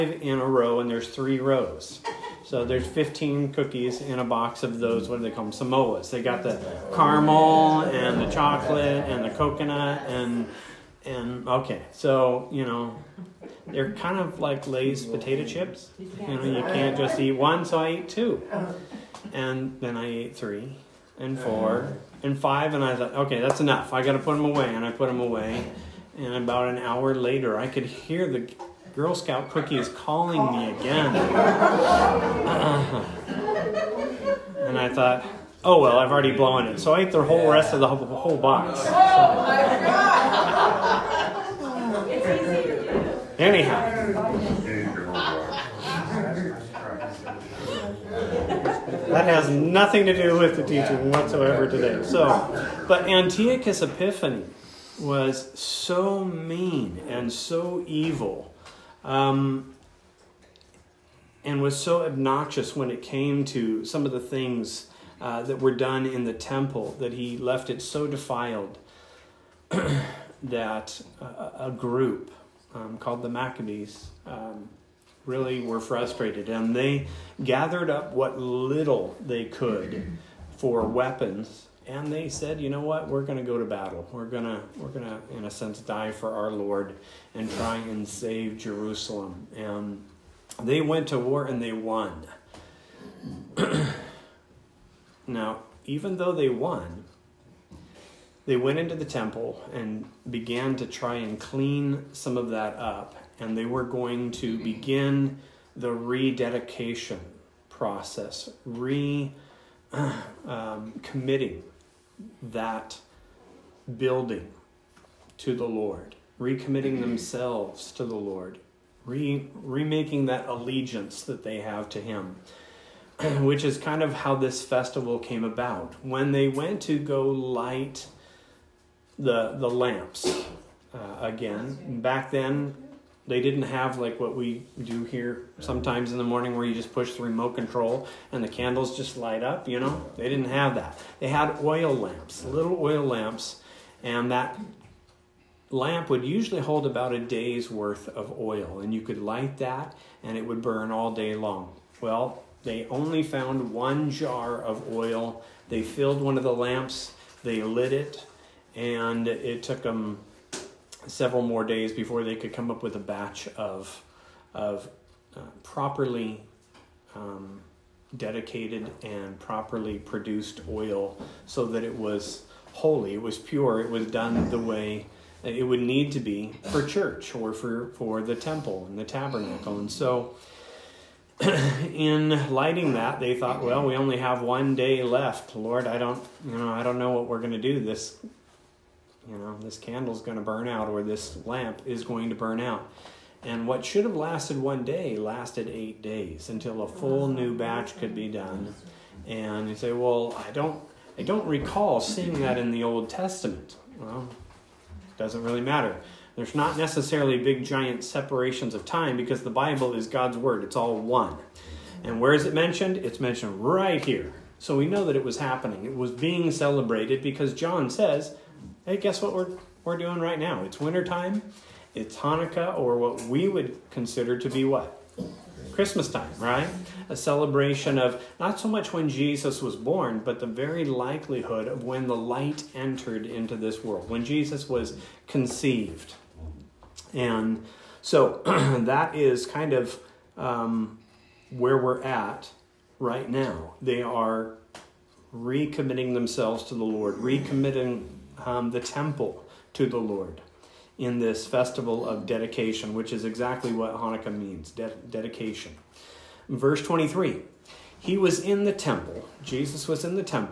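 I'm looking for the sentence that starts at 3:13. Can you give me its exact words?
And what should have lasted one day lasted eight days until a full new batch could be done.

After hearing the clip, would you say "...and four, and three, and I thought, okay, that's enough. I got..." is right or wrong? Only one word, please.
wrong.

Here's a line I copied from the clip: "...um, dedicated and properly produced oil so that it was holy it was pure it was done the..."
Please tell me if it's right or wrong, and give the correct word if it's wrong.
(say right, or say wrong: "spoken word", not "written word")
right.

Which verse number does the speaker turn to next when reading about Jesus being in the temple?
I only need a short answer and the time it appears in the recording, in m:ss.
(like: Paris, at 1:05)
23, at 4:16.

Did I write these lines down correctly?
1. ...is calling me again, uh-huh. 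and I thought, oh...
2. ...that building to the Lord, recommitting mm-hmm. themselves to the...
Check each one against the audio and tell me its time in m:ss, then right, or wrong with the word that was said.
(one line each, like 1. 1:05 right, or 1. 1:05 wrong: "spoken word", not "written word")
1. 0:29 right
2. 1:52 right.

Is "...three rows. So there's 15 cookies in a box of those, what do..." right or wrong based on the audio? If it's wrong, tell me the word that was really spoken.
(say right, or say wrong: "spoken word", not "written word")
right.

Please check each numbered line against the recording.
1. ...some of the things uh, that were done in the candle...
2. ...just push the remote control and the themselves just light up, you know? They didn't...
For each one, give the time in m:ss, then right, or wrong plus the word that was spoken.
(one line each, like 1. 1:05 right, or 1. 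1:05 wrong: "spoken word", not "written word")
1. 1:03 wrong: "temple", not "candle"
2. 2:16 wrong: "candles", not "themselves".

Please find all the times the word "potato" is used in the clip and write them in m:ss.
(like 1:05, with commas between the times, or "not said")
0:15.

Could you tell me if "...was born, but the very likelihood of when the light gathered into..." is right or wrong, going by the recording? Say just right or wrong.
wrong.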